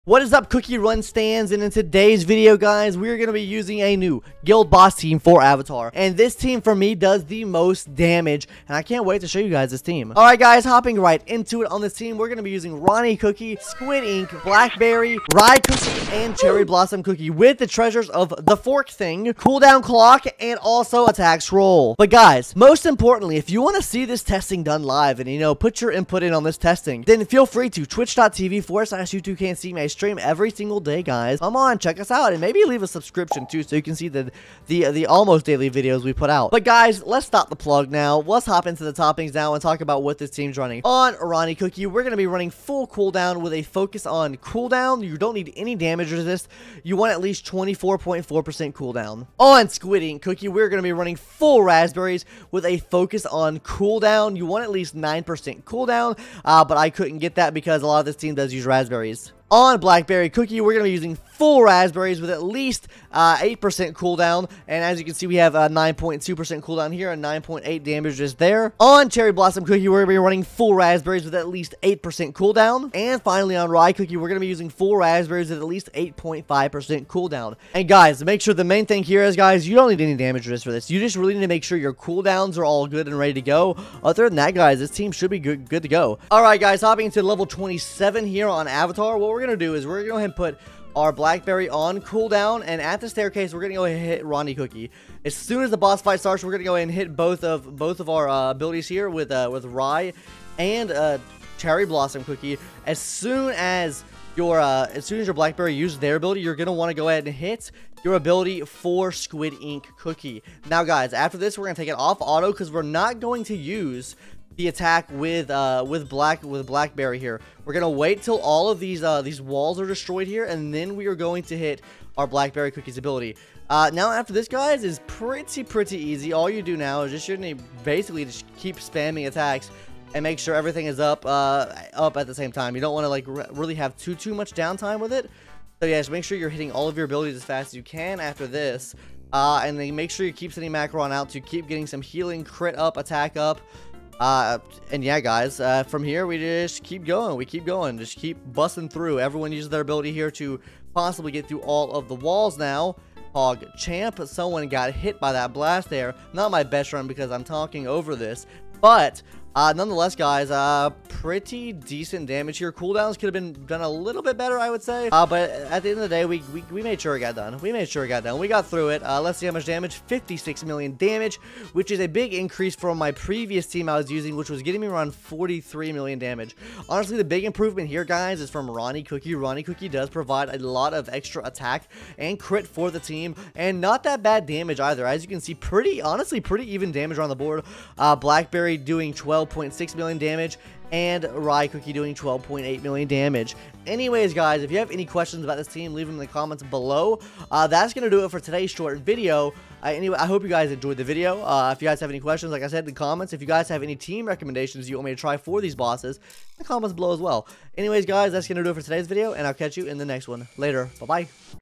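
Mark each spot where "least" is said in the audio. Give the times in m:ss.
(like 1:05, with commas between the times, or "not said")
0:47, 0:54, 1:02, 1:11, 1:15.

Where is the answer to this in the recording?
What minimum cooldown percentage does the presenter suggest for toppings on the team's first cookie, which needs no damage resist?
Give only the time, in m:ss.
0:47.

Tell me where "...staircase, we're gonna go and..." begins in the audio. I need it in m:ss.
1:33.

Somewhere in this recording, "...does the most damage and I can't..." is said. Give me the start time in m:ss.
0:06.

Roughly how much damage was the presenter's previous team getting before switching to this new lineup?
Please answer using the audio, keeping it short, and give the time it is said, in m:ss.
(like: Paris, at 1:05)
43 million, at 2:55.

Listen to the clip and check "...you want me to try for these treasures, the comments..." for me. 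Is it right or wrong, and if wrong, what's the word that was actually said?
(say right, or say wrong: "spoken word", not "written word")
wrong: "bosses", not "treasures".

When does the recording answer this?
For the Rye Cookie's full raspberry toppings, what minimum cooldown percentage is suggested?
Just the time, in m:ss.
1:15.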